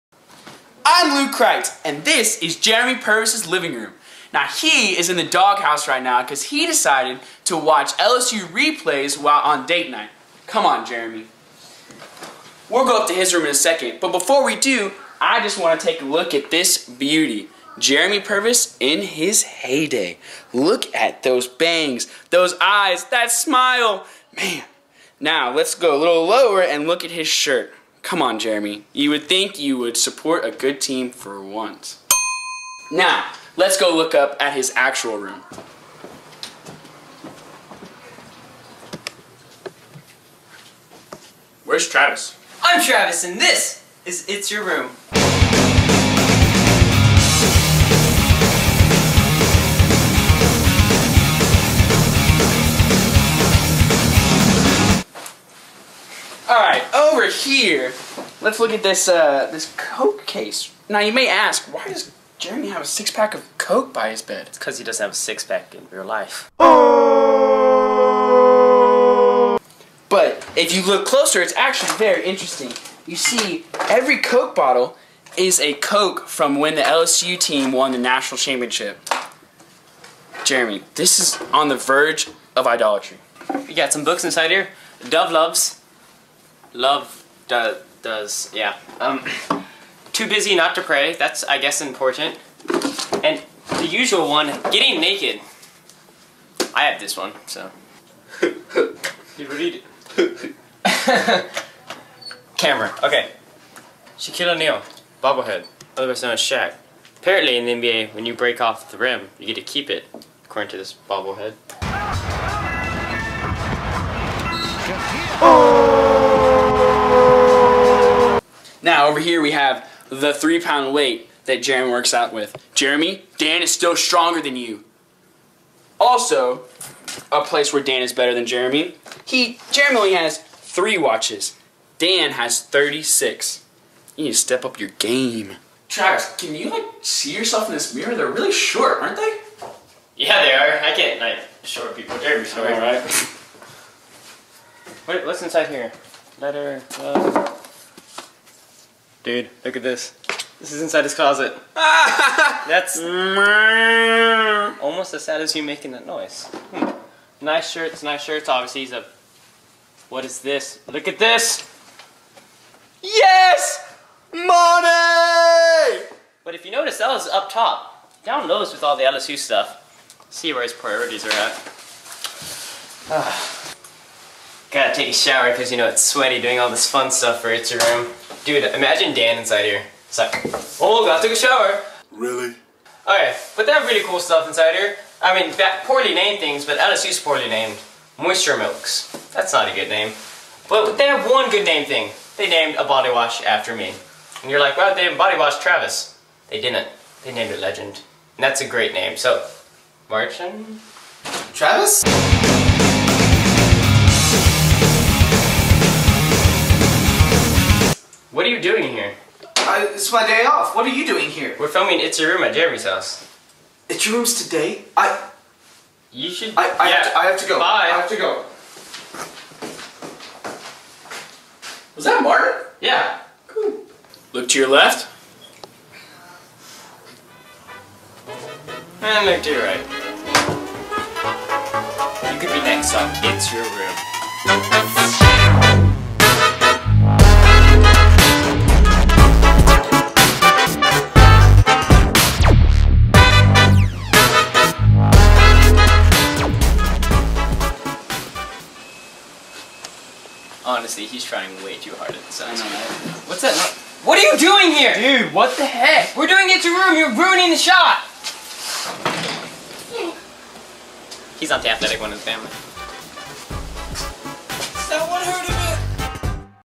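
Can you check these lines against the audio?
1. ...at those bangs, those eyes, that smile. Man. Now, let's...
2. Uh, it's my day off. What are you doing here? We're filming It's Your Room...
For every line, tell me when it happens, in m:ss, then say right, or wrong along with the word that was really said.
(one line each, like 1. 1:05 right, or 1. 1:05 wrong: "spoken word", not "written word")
1. 0:20 right
2. 3:29 right.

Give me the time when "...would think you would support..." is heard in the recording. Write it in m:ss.
0:29.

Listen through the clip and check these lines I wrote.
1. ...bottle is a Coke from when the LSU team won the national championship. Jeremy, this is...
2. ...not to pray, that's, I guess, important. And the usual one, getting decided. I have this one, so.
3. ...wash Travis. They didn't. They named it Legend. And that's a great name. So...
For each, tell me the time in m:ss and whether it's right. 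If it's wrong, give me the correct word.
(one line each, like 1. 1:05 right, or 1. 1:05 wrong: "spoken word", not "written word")
1. 1:14 right
2. 1:30 wrong: "naked", not "decided"
3. 3:15 right.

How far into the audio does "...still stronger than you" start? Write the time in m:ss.
2:03.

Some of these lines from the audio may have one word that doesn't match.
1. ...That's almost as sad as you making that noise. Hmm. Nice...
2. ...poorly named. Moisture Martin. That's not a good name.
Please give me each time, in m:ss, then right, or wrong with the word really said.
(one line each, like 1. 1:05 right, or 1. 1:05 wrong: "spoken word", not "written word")
1. 2:31 right
2. 3:07 wrong: "Milks", not "Martin".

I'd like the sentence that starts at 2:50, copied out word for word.
See where his priorities are at.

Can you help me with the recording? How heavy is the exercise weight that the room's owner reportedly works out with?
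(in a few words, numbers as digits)
3 pounds.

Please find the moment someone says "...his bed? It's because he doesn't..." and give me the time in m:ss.
1:04.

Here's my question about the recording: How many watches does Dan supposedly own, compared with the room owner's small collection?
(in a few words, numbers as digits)
36.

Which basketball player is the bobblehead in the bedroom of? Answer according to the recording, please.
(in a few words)
Shaquille O'Neal.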